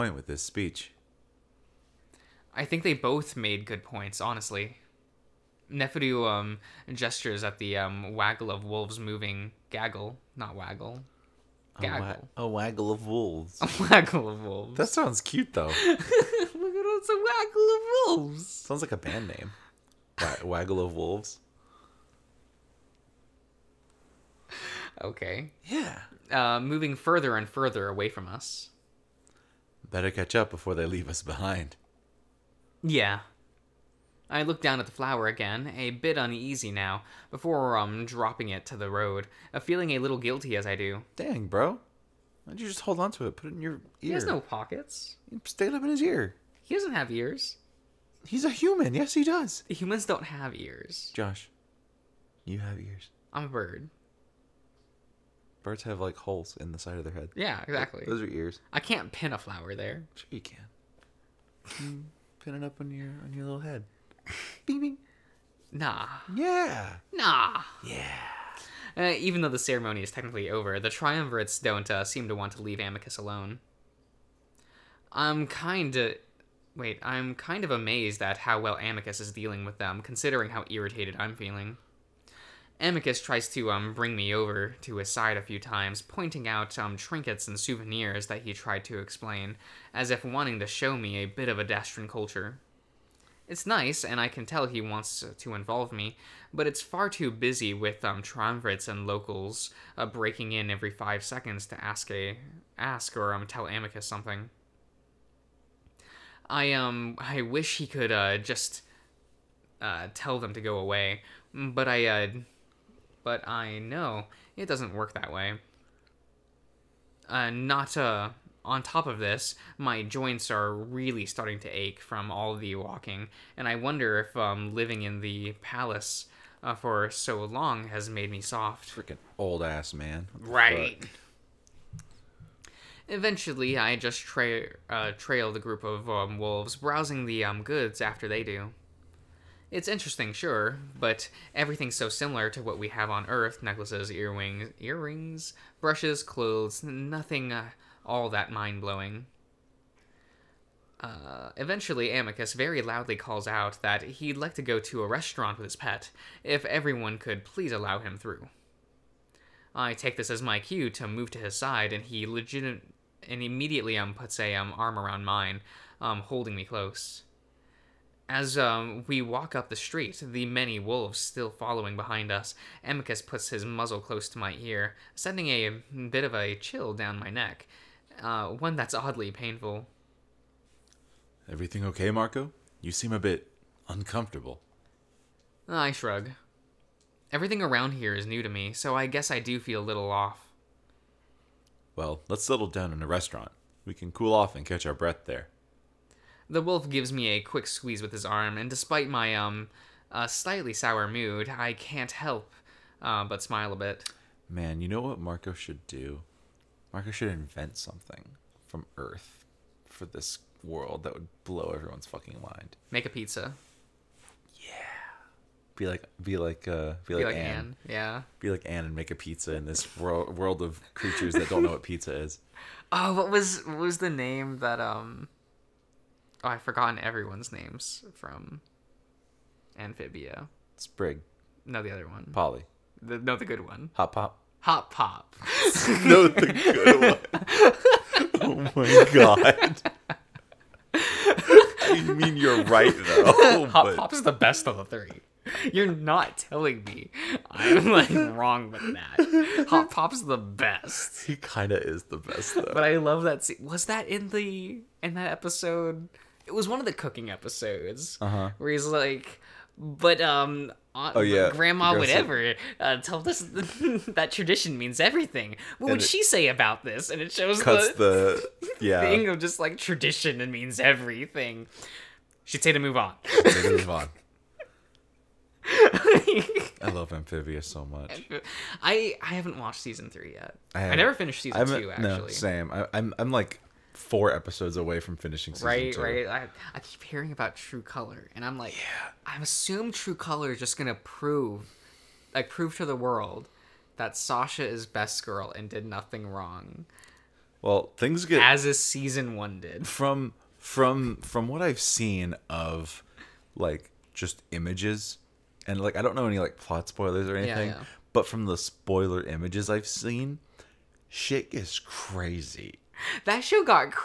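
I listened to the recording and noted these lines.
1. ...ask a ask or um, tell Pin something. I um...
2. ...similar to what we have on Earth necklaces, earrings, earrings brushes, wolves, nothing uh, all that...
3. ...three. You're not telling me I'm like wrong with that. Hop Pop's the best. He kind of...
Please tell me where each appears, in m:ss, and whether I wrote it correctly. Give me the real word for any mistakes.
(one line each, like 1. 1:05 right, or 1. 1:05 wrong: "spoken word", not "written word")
1. 1:41 wrong: "Amicus", not "Pin"
2. 2:22 wrong: "clothes", not "wolves"
3. 4:04 right.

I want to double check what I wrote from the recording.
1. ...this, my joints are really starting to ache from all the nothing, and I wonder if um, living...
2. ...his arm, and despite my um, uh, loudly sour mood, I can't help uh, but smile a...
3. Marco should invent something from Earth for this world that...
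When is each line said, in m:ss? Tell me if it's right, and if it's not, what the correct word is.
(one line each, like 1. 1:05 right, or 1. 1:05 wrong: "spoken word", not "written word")
1. 1:59 wrong: "walking", not "nothing"
2. 3:18 wrong: "slightly", not "loudly"
3. 3:26 right.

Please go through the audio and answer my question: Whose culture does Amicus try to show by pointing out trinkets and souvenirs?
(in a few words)
Adastran.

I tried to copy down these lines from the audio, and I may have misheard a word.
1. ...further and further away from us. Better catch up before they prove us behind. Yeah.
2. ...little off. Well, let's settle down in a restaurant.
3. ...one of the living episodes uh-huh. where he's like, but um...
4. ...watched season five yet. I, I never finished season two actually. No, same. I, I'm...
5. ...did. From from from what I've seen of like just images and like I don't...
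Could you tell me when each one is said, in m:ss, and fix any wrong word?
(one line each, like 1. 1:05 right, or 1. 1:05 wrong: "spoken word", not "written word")
1. 0:26 wrong: "leave", not "prove"
2. 3:09 right
3. 4:16 wrong: "cooking", not "living"
4. 4:39 wrong: "three", not "five"
5. 4:59 right.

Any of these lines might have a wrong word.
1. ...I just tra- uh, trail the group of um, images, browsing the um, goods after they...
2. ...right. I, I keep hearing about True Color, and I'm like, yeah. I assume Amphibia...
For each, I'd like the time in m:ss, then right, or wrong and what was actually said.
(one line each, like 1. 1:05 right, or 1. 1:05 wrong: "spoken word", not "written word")
1. 2:13 wrong: "wolves", not "images"
2. 4:46 wrong: "True", not "Amphibia".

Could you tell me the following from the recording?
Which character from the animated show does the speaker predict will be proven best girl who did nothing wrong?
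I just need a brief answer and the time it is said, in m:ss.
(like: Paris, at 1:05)
Sasha, at 4:54.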